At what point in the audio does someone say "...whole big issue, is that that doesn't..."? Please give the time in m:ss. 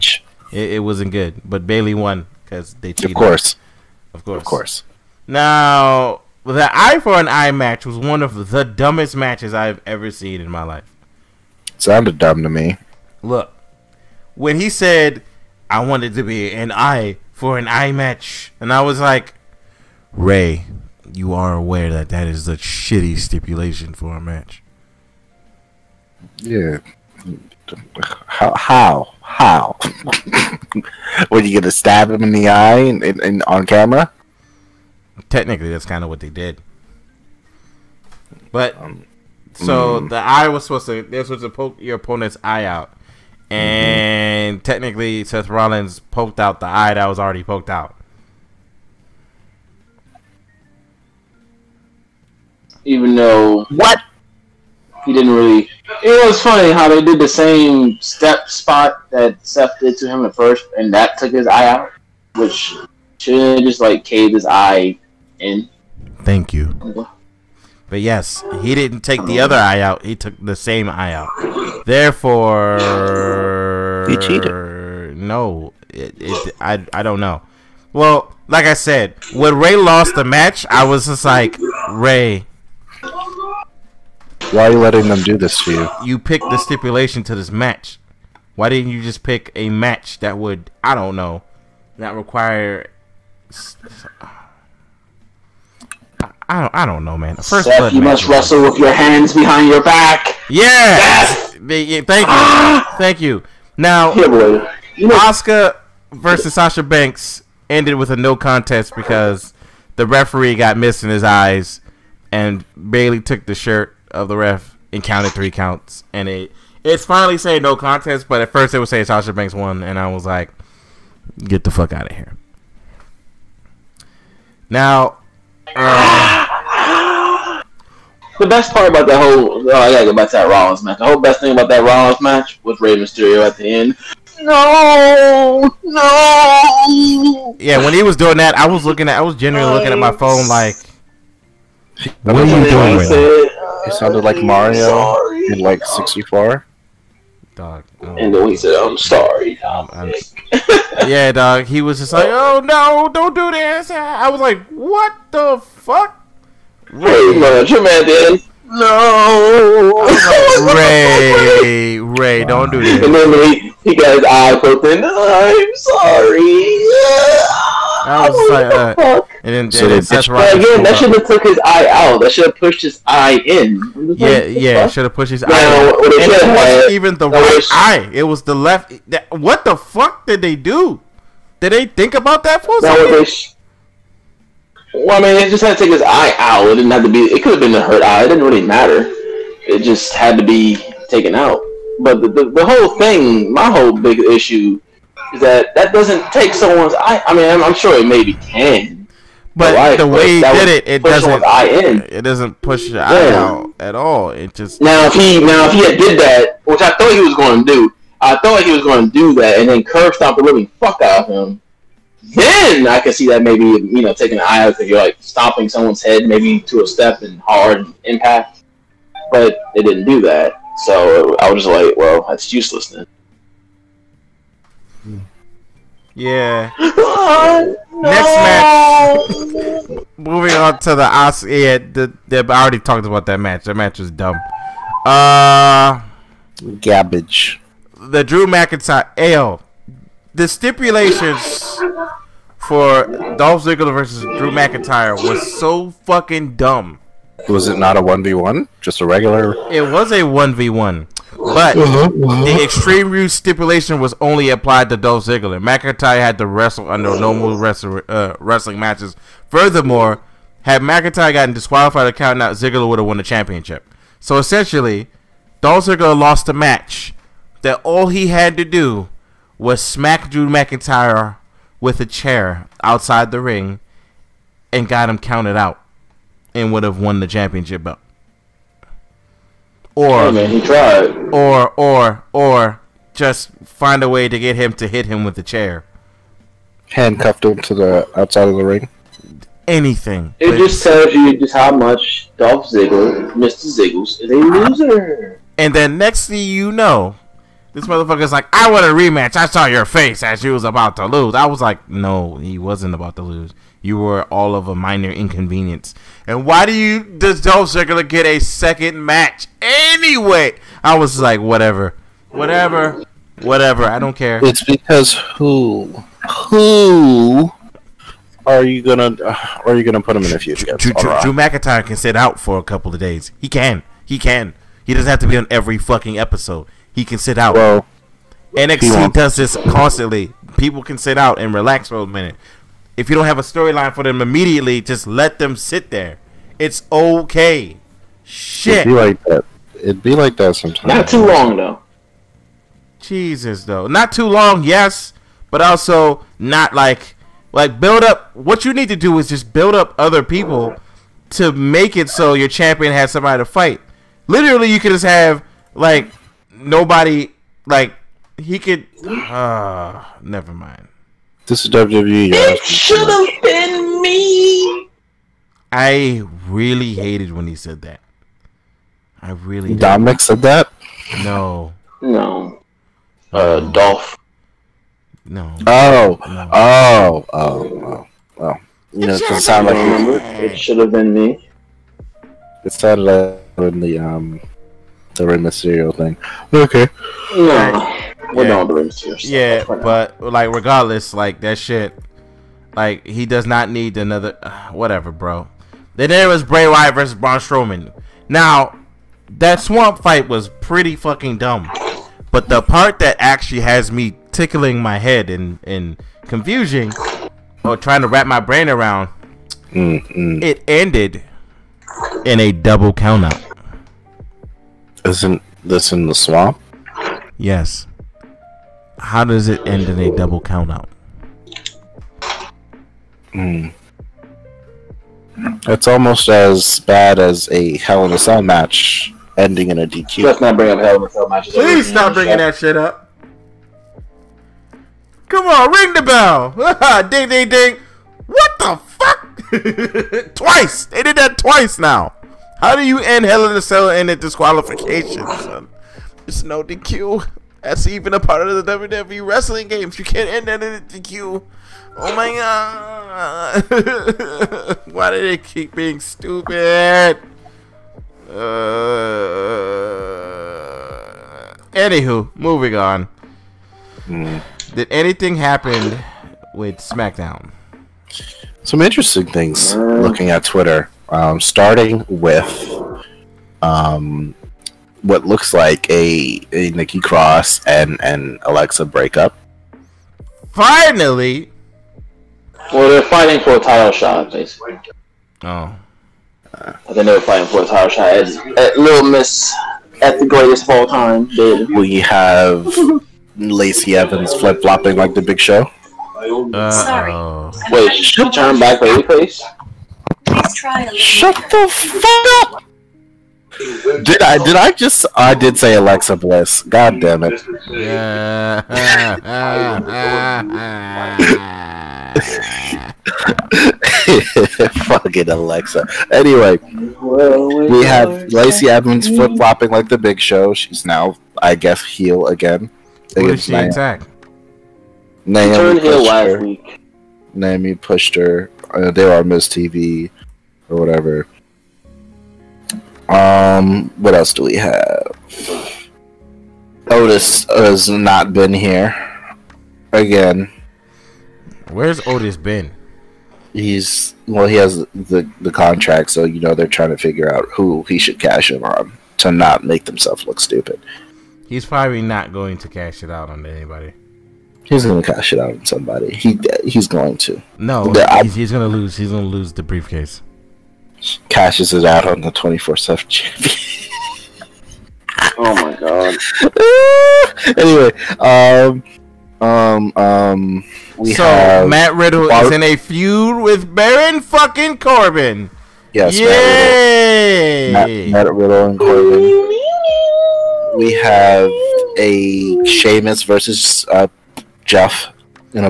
3:13.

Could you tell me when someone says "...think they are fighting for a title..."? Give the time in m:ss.
8:06.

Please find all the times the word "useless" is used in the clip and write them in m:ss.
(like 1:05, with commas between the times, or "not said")
3:42.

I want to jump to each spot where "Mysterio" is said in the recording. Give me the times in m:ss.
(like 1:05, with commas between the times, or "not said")
2:12, 6:25.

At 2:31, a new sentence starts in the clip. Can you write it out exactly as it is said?
He was just like, "Oh no, don't do this." I was like, "What the fuck?" Rey, much, man.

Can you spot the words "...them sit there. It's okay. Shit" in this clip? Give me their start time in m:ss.
5:35.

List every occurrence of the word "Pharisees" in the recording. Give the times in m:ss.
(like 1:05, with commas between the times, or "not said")
not said.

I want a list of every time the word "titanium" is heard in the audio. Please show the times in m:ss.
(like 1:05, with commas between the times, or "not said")
not said.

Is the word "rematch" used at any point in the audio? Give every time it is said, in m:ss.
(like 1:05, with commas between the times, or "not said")
4:58.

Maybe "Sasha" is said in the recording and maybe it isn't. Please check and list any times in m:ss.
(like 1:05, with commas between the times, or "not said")
1:46, 1:59.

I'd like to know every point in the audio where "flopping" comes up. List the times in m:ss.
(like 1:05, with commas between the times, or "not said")
8:14, 8:39.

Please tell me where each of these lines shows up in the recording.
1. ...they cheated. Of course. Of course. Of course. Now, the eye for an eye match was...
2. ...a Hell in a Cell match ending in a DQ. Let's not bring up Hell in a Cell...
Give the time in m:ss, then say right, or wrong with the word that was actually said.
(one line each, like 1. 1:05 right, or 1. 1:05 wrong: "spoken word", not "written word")
1. 0:02 right
2. 7:07 right.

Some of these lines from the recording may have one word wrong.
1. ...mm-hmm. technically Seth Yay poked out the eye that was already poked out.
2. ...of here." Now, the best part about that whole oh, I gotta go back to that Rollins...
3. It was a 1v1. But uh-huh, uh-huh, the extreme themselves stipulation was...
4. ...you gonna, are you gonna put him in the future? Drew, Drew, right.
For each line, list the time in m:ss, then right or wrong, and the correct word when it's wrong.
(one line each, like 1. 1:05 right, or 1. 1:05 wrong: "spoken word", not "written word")
1. 0:44 wrong: "Rollins", not "Yay"
2. 2:02 right
3. 4:09 wrong: "rules", not "themselves"
4. 5:18 right.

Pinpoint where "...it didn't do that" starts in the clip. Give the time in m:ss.
3:39.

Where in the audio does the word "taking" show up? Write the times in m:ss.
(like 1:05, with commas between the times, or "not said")
3:34.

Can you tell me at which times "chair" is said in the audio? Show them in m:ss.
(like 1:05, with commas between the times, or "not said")
4:32, 4:45.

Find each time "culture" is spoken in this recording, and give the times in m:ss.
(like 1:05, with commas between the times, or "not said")
not said.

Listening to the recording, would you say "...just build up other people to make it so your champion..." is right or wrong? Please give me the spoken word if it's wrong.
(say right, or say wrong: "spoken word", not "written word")
right.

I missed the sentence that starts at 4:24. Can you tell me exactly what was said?
So essentially, Dolph Ziggler lost a match.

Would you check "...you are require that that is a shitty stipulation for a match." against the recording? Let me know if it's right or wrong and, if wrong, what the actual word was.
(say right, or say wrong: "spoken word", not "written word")
wrong: "aware", not "require".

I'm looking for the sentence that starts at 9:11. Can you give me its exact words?
He's probably not going to cash it out on anybody.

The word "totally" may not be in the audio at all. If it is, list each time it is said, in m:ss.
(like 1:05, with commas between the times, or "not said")
not said.